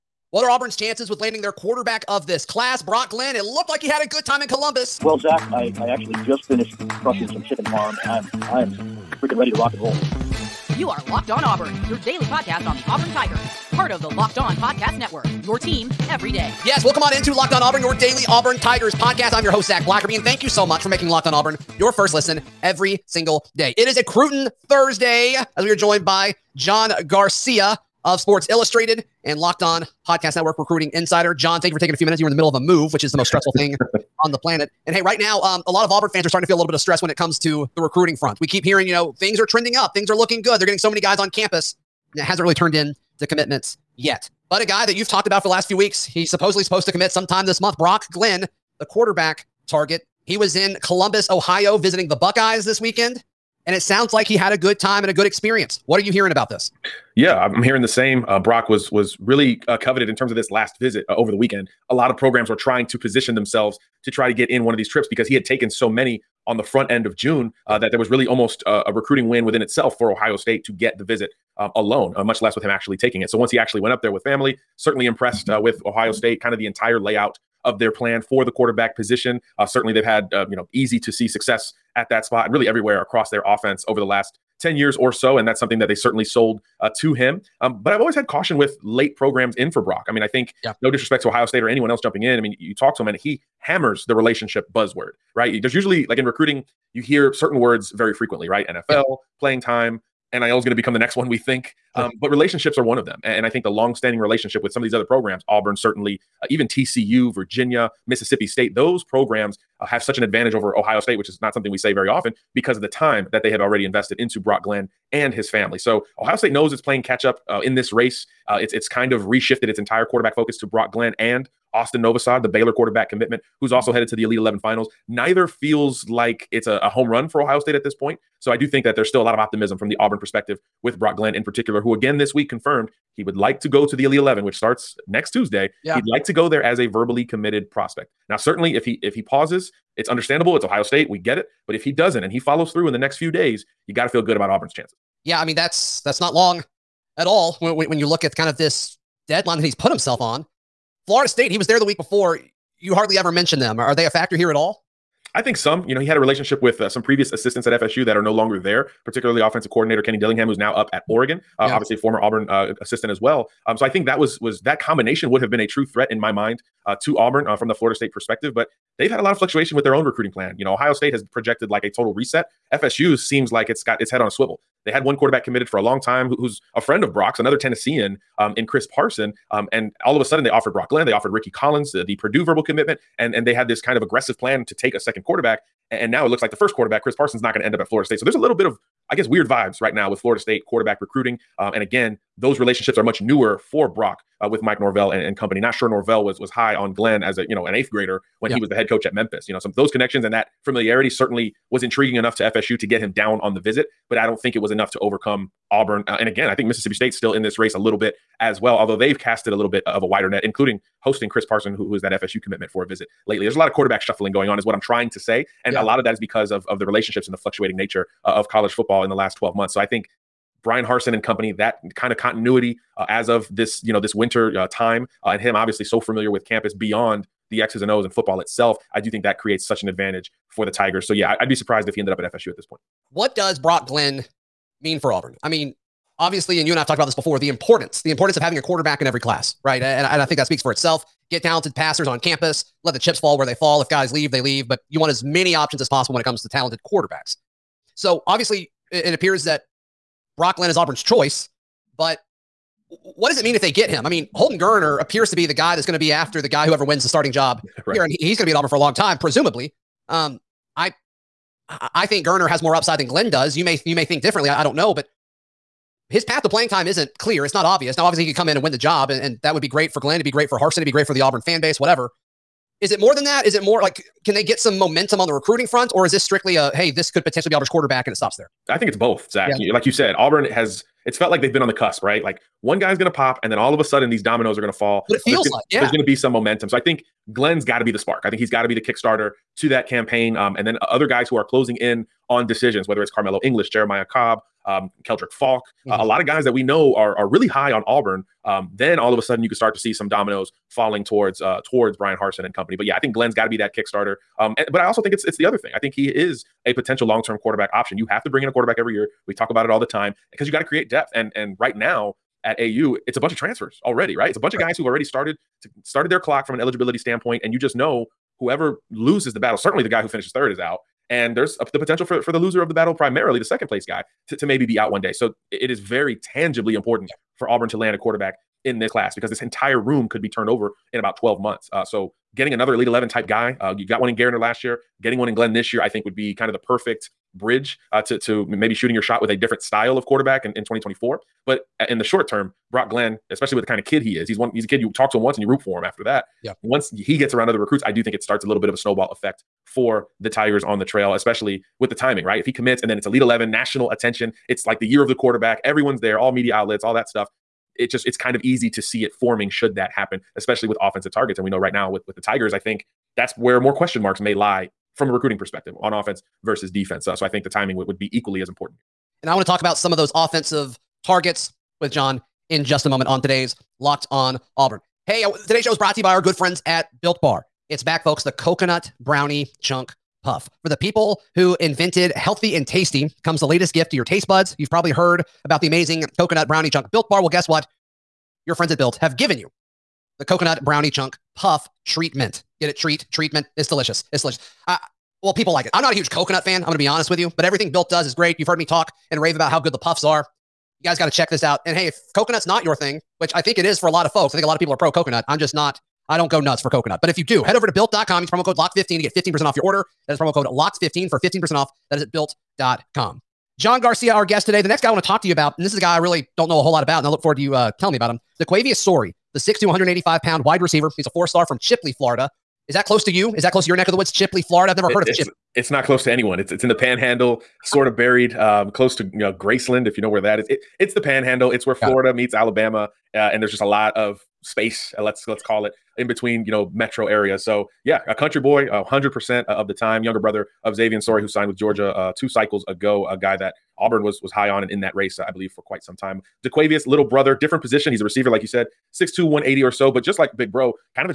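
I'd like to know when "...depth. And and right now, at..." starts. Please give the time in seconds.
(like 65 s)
310 s.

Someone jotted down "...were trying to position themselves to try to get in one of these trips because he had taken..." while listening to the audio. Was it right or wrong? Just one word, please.
right.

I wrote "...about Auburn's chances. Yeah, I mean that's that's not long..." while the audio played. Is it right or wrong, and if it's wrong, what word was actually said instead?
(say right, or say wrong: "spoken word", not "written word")
right.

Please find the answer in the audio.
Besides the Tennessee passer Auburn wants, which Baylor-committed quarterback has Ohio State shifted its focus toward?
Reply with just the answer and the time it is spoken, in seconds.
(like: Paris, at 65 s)
Austin Novosad, at 121 s.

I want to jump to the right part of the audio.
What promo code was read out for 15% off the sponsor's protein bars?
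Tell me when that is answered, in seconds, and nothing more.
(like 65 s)
408 s.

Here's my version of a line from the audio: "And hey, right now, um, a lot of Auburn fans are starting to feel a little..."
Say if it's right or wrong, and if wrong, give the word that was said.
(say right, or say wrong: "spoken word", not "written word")
right.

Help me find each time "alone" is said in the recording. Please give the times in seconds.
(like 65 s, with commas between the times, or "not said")
71 s.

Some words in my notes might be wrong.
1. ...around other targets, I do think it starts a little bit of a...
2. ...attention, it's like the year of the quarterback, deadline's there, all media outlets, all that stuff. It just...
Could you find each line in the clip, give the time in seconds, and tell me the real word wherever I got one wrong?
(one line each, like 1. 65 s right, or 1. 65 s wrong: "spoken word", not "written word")
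1. 347 s wrong: "recruits", not "targets"
2. 353 s wrong: "everyone", not "deadline".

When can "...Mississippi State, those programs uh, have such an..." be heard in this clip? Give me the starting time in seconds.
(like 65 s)
108 s.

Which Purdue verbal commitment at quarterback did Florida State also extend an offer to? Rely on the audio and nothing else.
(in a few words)
Ricky Collins.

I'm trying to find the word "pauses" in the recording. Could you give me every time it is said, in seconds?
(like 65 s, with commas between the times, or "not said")
139 s.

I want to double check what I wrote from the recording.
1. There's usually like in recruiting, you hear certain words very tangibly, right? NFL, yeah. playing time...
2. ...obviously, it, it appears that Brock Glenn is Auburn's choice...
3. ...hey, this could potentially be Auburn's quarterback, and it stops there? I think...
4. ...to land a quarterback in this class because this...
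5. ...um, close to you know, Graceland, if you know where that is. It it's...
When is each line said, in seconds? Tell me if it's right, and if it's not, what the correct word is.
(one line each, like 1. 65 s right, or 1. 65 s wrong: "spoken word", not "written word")
1. 95 s wrong: "frequently", not "tangibly"
2. 248 s right
3. 276 s right
4. 327 s right
5. 428 s right.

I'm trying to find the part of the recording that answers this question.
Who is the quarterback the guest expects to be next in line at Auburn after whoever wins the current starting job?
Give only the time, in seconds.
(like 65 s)
254 s.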